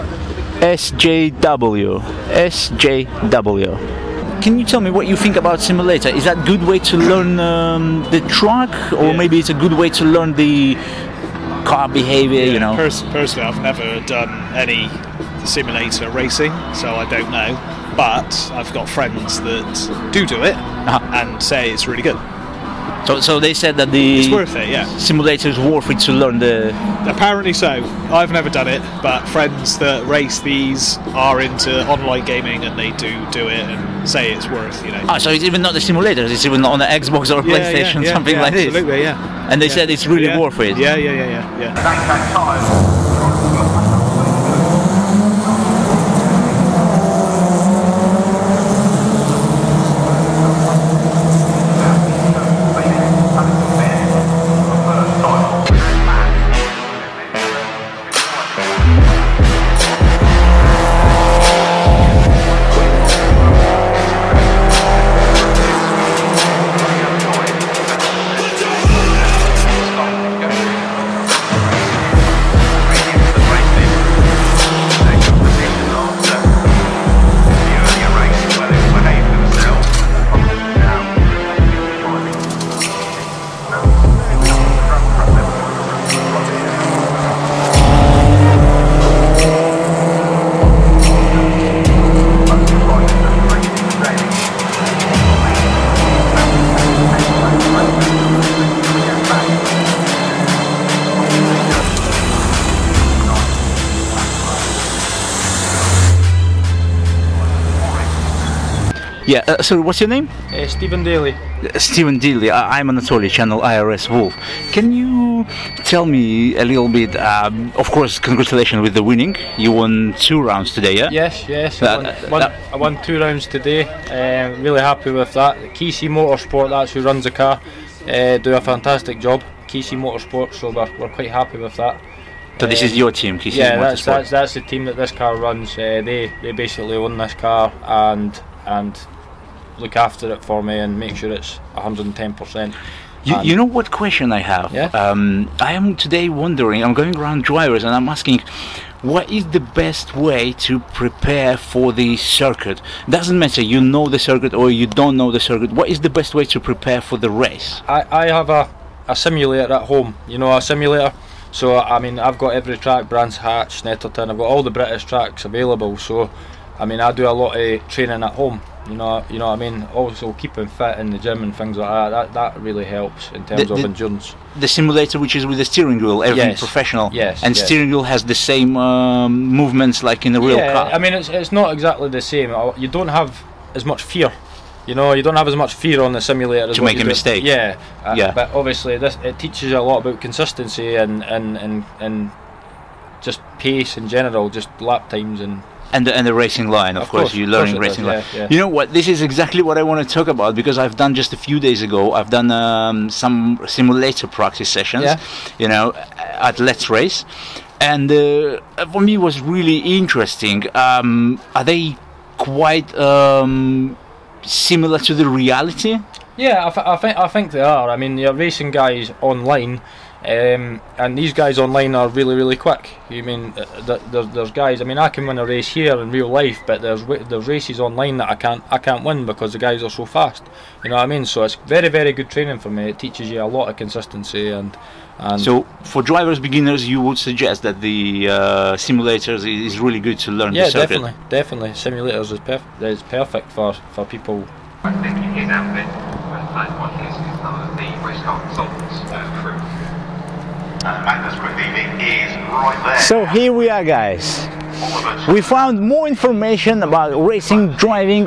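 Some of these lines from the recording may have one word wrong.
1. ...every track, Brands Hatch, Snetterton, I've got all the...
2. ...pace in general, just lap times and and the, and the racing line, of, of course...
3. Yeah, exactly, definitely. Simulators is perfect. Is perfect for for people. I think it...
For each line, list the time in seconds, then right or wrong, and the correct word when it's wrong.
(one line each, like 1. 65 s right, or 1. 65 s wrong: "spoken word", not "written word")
1. 162 s right
2. 193 s right
3. 240 s wrong: "definitely", not "exactly".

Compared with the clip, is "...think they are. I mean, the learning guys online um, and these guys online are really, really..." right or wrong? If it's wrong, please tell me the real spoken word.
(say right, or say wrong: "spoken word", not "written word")
wrong: "racing", not "learning".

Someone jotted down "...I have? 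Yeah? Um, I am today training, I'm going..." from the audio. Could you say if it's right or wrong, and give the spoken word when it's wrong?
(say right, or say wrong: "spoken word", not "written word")
wrong: "wondering", not "training".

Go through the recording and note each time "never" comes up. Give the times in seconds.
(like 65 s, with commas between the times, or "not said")
13 s, 28 s.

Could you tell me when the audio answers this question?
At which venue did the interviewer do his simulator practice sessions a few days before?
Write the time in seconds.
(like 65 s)
206 s.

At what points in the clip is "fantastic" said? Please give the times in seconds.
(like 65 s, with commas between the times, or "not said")
128 s.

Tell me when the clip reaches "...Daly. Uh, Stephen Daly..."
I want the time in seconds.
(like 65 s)
111 s.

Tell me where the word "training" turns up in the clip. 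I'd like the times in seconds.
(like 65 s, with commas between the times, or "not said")
167 s, 232 s.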